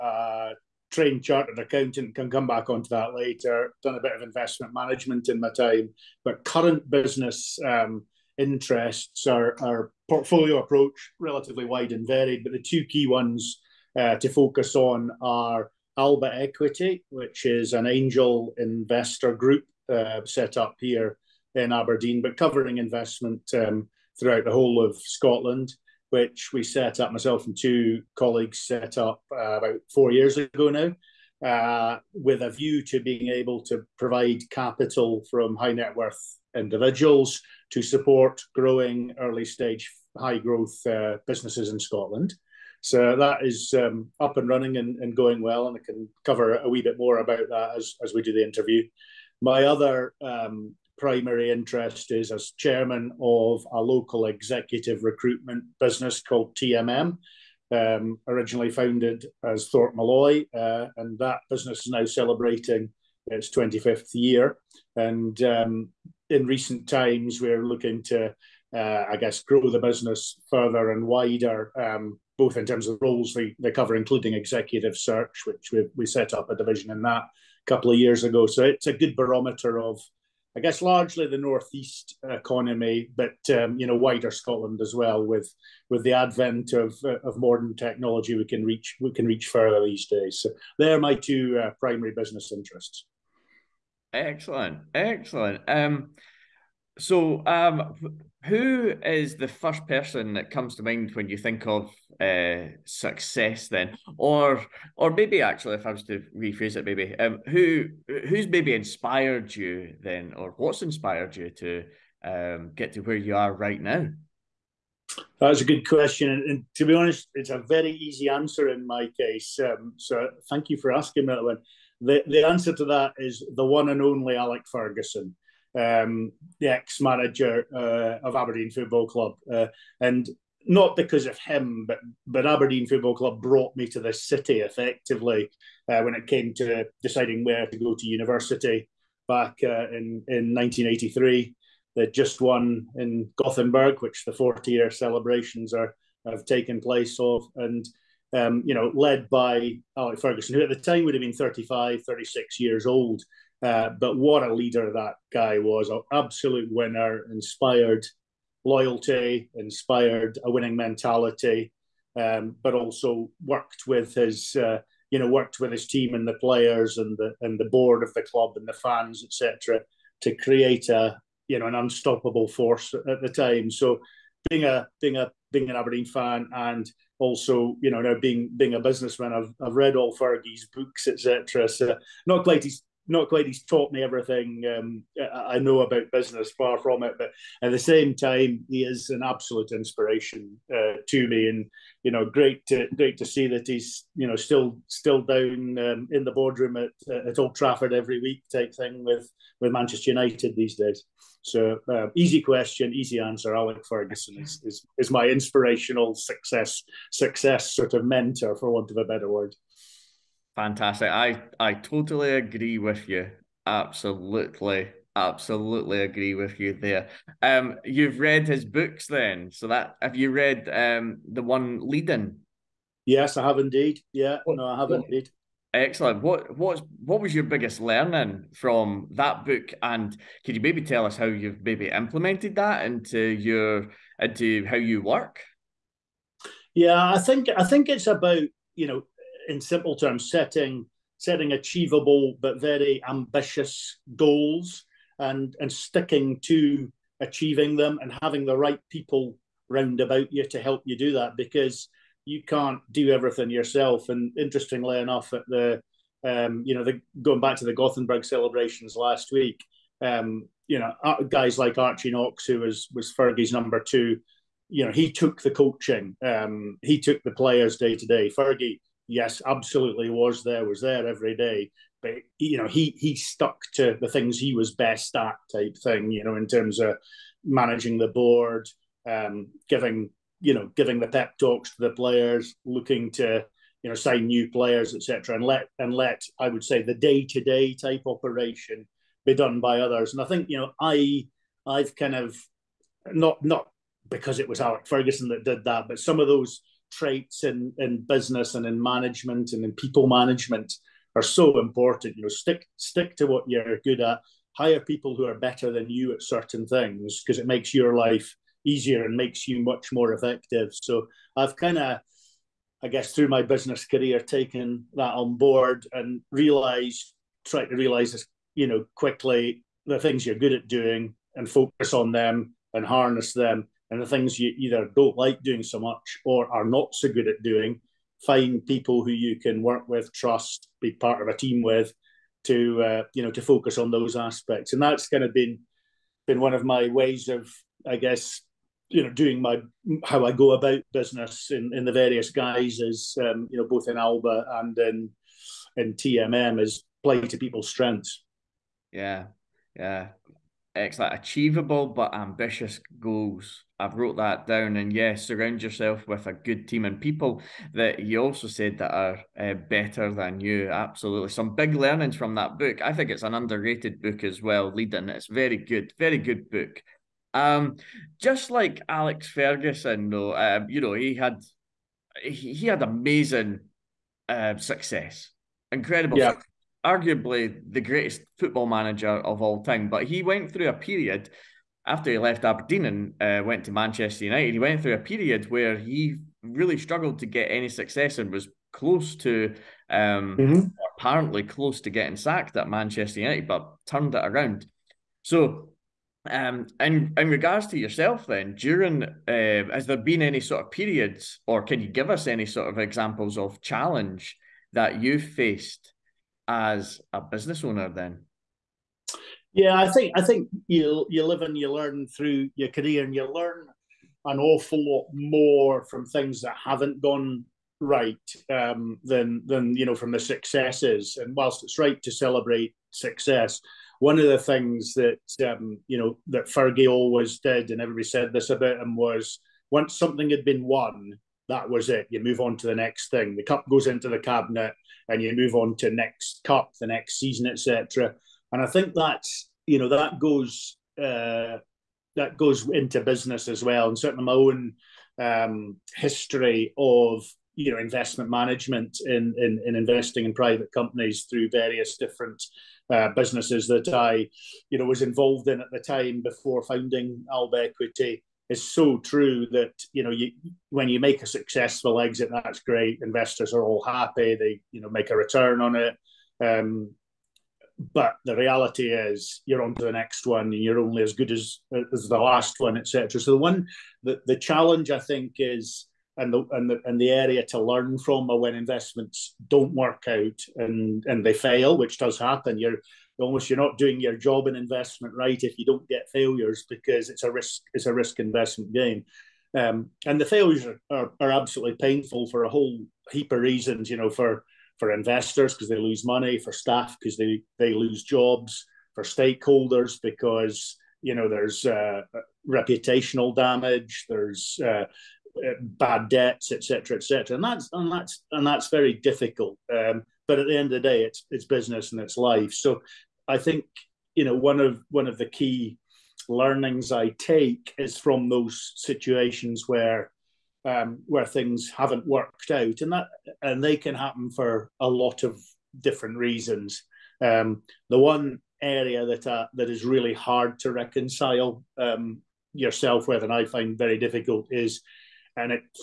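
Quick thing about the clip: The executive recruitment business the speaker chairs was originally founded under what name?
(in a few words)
Thorpe Malloy.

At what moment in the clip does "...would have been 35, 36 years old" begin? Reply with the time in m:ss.
2:31.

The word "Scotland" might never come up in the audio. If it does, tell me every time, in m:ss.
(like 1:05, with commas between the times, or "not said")
0:24, 0:41, 1:24.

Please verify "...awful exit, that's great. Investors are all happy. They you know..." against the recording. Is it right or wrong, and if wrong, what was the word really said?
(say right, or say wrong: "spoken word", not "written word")
wrong: "successful", not "awful".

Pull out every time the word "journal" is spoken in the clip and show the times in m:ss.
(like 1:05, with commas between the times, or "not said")
not said.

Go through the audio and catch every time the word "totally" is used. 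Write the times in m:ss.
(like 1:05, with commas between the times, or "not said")
3:31.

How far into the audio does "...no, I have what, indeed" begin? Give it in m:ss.
3:44.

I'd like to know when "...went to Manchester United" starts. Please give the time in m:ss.
6:23.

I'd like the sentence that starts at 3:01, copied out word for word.
So not quite his not quite he's taught me everything um, I know about business, far from it.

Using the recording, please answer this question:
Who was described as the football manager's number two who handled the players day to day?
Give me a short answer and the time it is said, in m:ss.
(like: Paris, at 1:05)
Archie Knox, at 4:21.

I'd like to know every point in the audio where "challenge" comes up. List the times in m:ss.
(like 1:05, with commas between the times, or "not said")
6:43, 7:54.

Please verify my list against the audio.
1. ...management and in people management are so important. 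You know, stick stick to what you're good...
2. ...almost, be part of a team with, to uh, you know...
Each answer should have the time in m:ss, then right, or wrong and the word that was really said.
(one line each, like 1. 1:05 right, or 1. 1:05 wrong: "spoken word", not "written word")
1. 4:58 right
2. 5:30 wrong: "trust", not "almost".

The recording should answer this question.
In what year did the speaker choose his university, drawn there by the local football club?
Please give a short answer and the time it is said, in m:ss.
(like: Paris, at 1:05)
1983, at 2:20.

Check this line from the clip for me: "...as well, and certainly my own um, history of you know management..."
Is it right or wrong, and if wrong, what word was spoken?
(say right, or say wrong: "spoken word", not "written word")
wrong: "investment", not "management".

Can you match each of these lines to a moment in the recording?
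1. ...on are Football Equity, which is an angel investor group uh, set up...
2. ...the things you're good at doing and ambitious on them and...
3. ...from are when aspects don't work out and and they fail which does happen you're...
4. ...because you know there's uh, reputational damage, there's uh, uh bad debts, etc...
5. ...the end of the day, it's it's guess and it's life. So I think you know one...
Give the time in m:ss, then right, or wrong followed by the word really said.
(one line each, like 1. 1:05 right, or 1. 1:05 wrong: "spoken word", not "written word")
1. 0:14 wrong: "Alba", not "Football"
2. 5:19 wrong: "focus", not "ambitious"
3. 7:57 wrong: "investments", not "aspects"
4. 8:20 right
5. 8:30 wrong: "business", not "guess".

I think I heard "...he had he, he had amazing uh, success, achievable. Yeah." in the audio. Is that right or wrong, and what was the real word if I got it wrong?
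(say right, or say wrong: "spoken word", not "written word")
wrong: "incredible", not "achievable".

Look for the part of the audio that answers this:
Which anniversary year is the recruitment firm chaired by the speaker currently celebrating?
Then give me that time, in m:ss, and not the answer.
1:03.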